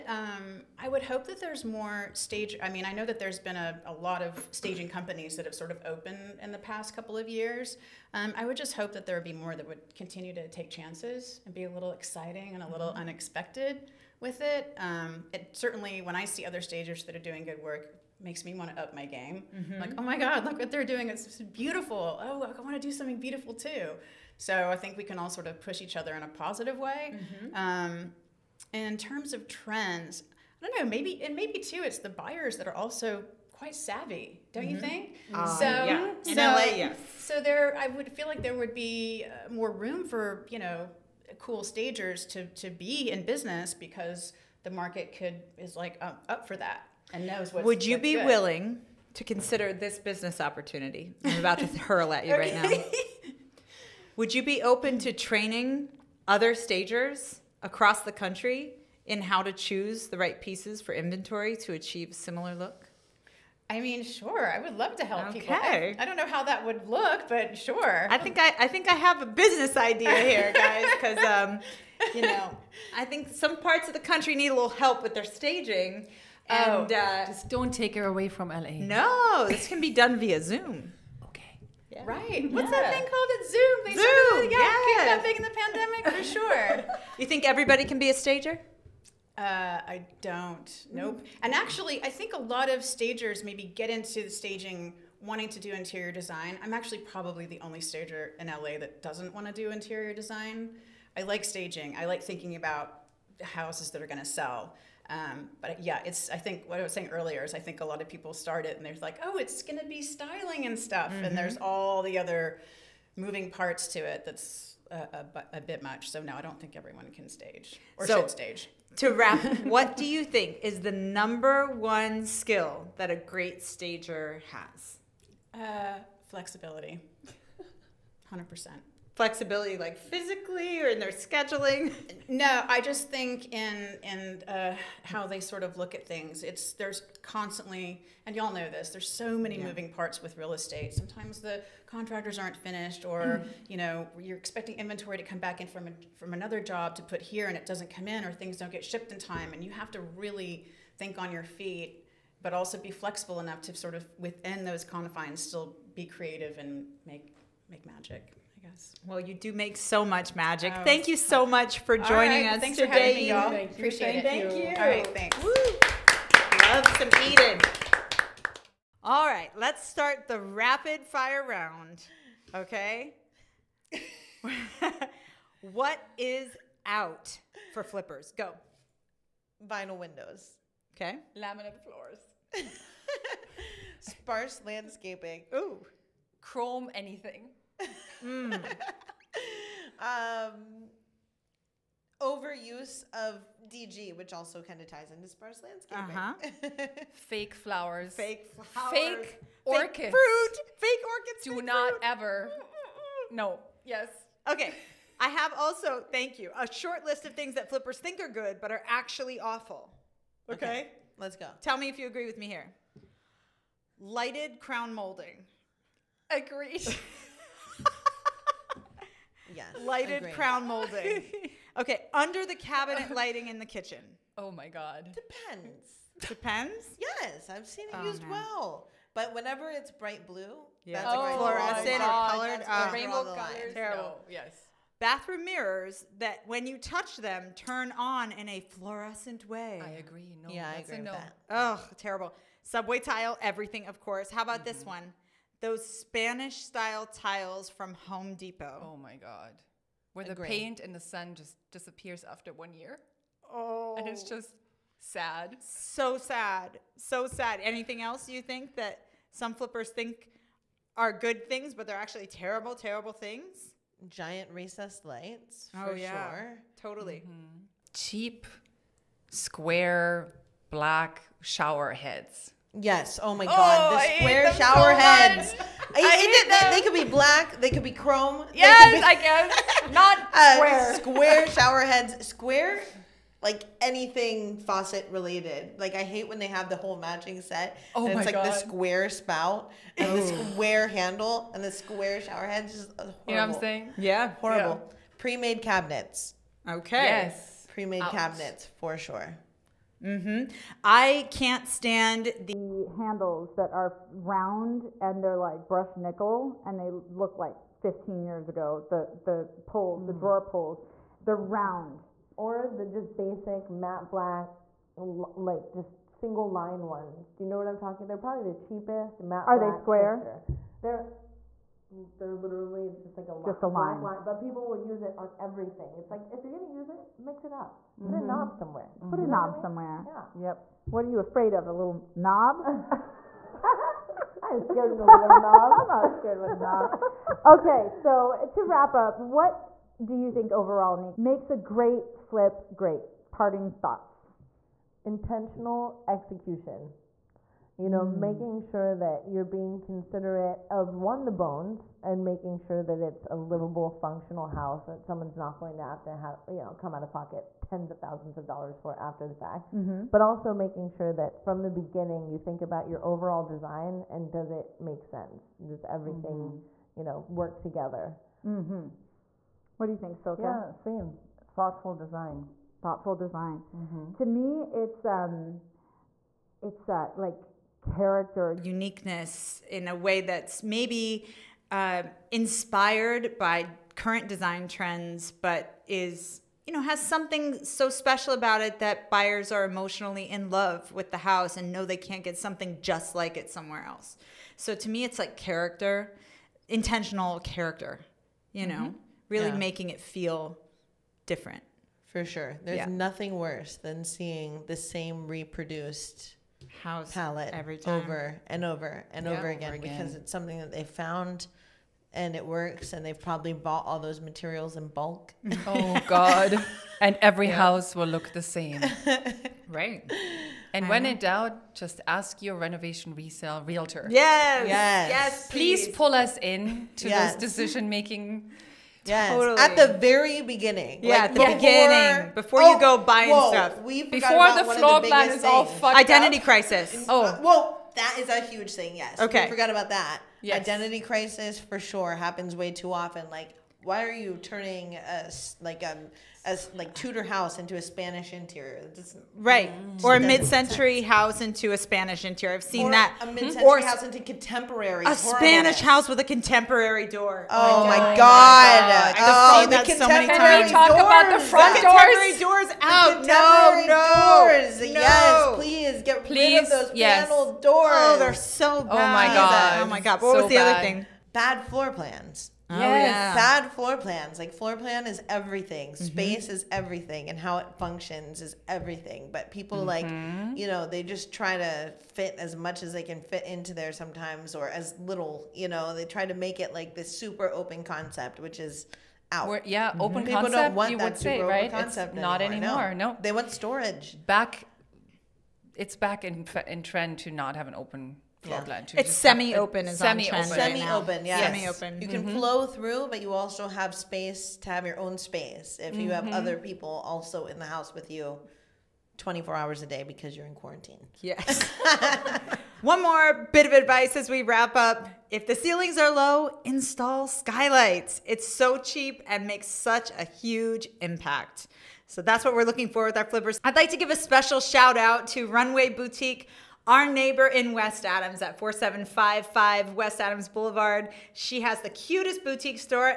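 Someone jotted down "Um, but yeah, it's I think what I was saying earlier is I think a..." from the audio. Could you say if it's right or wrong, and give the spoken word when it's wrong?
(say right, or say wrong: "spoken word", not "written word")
right.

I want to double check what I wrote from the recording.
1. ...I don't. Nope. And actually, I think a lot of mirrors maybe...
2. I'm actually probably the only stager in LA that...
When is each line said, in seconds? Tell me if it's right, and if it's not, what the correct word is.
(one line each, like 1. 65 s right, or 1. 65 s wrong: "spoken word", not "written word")
1. 89 s wrong: "stagers", not "mirrors"
2. 96 s right.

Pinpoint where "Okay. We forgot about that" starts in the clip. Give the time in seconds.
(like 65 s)
439 s.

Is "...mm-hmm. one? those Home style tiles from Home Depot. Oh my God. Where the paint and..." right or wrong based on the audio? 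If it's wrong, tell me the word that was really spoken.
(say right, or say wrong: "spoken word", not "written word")
wrong: "Spanish", not "Home".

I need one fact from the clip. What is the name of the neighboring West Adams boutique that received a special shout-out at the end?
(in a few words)
Runway Boutique.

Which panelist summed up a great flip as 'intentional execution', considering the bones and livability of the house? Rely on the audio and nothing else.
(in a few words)
Nick.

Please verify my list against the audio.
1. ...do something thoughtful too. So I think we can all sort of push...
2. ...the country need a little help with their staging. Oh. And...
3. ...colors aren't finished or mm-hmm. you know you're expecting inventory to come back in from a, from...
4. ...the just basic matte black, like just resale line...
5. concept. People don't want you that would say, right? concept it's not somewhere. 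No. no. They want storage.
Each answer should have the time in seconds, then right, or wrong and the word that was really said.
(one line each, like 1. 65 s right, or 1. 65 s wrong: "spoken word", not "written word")
1. 22 s wrong: "beautiful", not "thoughtful"
2. 73 s right
3. 141 s wrong: "contractors", not "colors"
4. 312 s wrong: "single", not "resale"
5. 490 s wrong: "anymore", not "somewhere".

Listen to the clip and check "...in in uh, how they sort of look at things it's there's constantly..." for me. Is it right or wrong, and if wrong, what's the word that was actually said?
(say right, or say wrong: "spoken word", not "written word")
right.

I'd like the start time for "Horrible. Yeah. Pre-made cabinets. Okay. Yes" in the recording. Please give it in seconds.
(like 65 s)
294 s.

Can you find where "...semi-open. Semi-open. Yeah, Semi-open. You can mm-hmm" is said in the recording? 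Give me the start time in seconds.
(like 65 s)
499 s.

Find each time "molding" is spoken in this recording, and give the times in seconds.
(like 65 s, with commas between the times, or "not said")
214 s, 220 s.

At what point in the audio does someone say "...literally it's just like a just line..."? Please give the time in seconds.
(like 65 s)
322 s.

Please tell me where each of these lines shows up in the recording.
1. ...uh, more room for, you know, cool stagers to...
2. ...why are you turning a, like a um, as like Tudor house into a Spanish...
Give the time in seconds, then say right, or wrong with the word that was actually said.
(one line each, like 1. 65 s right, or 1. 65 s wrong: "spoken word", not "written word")
1. 39 s right
2. 443 s right.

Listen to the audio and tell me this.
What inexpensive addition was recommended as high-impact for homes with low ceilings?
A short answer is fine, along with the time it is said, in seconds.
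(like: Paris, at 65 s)
Skylights, at 517 s.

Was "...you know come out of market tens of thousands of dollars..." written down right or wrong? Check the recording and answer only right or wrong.
wrong.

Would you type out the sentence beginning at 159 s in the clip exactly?
Well, you do make so much magic.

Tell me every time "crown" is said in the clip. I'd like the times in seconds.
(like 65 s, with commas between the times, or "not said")
214 s, 220 s.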